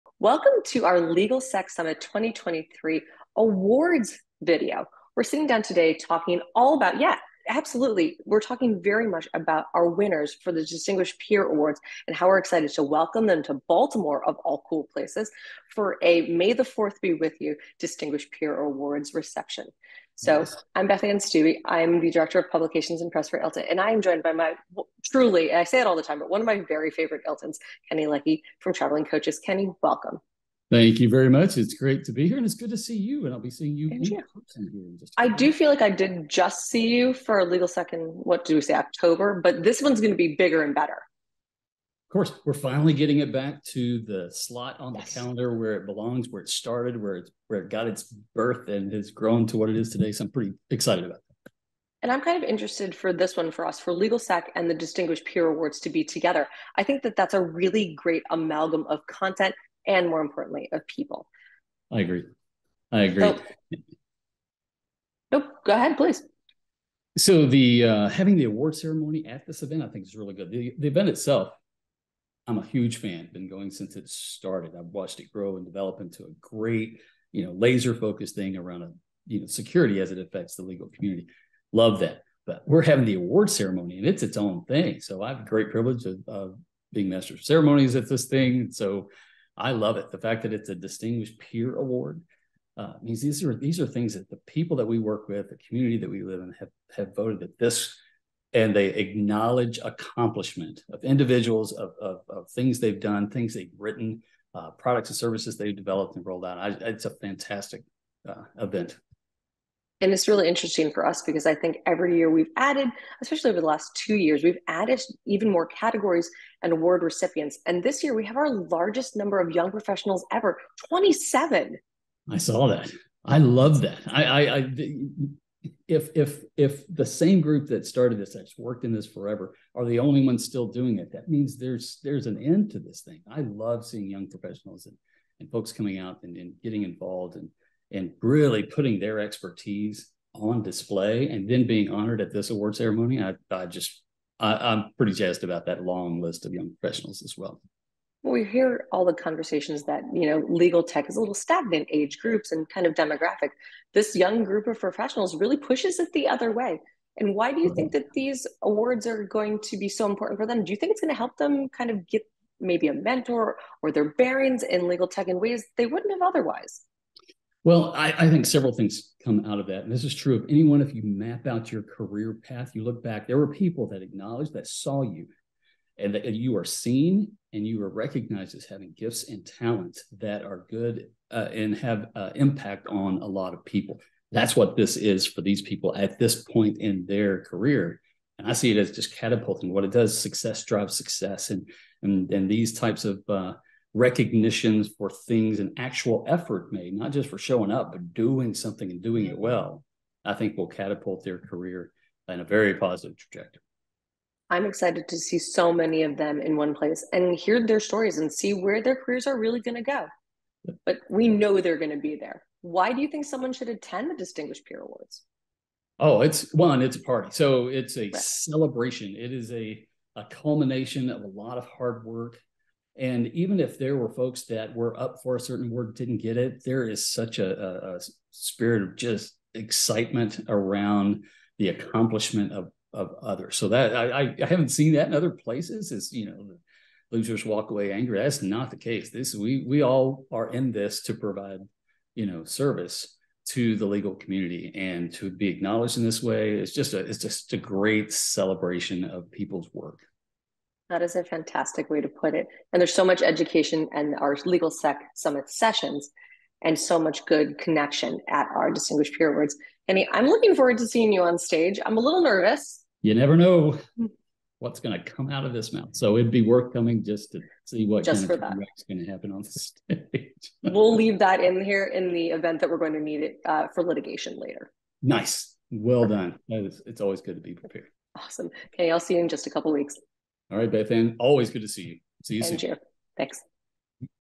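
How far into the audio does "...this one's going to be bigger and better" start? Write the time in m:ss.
0:39.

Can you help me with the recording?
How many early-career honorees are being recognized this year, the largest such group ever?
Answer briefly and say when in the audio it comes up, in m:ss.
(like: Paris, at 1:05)
27, at 2:00.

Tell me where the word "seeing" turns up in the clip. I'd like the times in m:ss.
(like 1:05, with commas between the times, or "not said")
0:33, 2:13, 4:20.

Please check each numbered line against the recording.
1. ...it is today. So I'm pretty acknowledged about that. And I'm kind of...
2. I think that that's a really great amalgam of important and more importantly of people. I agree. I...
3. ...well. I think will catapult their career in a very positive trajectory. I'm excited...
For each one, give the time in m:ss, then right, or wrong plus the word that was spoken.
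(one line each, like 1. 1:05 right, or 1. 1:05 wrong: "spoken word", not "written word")
1. 0:49 wrong: "excited", not "acknowledged"
2. 0:56 wrong: "content", not "important"
3. 3:19 right.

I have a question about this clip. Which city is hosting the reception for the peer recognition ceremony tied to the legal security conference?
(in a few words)
Baltimore.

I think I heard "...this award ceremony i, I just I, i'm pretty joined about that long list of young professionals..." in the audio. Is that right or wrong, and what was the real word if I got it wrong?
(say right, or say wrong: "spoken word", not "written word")
wrong: "jazzed", not "joined".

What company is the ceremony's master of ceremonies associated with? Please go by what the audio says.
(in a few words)
Traveling Coaches.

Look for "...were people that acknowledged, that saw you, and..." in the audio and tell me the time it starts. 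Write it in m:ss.
2:53.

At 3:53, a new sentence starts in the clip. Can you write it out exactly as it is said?
So that I, I haven't seen that in other places.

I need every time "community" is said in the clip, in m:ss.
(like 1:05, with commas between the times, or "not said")
1:20, 1:35, 4:04.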